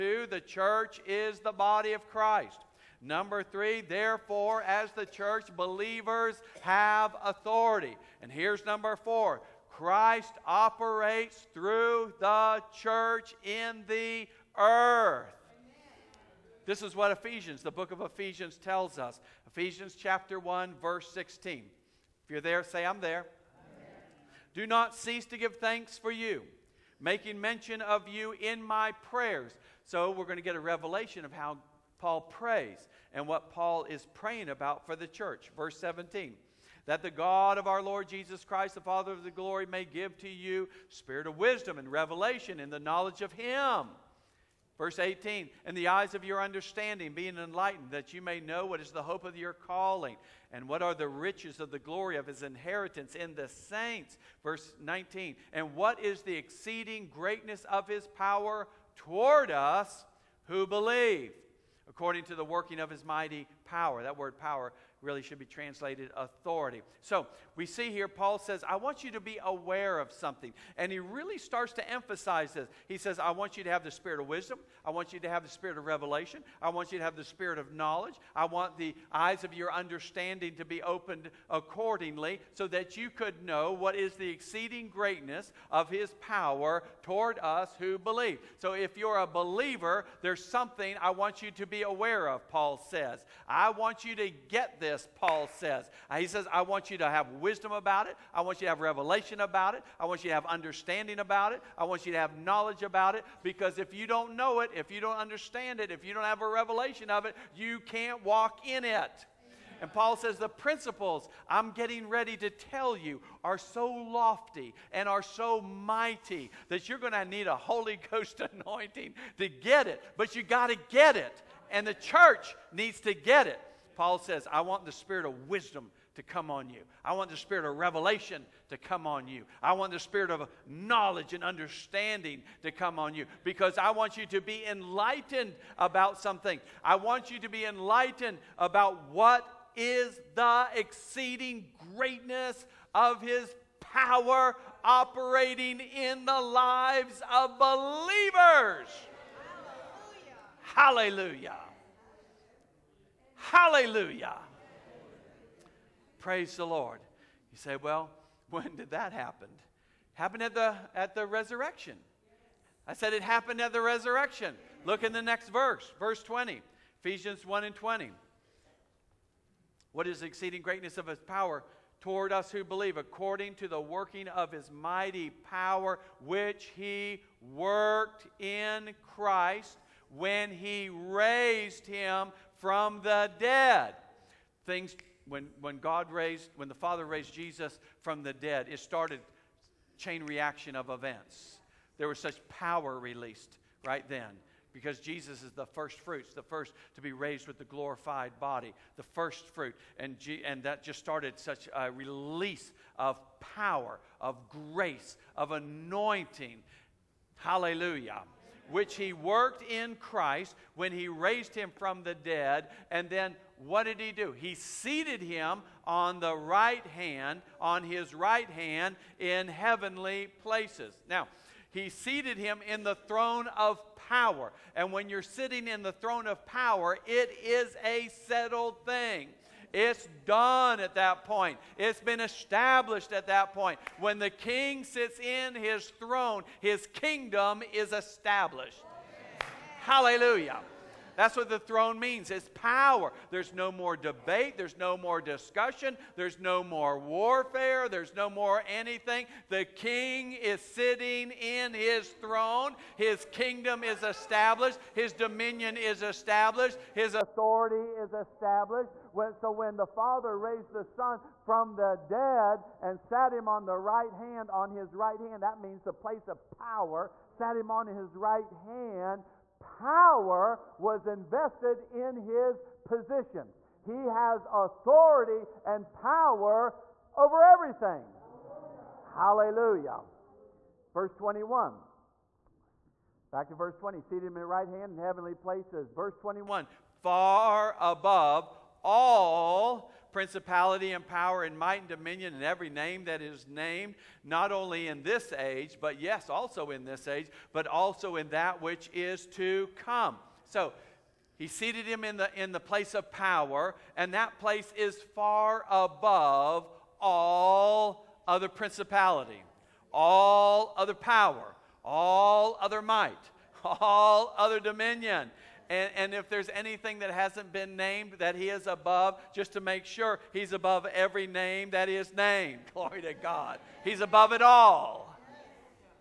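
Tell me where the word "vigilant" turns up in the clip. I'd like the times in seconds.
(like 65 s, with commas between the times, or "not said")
not said.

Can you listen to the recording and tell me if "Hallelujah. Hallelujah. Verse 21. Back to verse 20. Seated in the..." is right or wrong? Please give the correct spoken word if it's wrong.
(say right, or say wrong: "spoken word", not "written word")
right.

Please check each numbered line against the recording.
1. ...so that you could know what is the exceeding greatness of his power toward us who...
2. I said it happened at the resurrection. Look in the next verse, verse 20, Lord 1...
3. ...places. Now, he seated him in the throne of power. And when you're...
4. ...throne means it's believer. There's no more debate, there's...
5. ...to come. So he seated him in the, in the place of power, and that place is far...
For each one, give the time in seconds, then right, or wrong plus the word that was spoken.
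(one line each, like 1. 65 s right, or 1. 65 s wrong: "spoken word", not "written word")
1. 82 s right
2. 162 s wrong: "Ephesians", not "Lord"
3. 220 s right
4. 241 s wrong: "power", not "believer"
5. 299 s right.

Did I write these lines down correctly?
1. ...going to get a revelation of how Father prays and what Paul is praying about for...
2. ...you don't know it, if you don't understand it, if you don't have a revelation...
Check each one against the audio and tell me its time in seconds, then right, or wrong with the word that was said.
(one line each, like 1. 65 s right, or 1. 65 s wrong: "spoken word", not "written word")
1. 30 s wrong: "Paul", not "Father"
2. 103 s right.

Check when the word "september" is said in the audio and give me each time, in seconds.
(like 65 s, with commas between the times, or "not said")
not said.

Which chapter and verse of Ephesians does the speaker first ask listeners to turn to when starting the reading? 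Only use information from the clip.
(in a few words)
Ephesians 1:16.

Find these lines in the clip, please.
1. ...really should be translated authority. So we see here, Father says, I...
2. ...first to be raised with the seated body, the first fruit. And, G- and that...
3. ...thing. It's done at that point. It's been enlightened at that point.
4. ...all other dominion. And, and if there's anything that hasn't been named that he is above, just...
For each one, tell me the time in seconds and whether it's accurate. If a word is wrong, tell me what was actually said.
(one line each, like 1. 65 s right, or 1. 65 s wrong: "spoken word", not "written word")
1. 65 s wrong: "Paul", not "Father"
2. 196 s wrong: "glorified", not "seated"
3. 228 s wrong: "established", not "enlightened"
4. 313 s right.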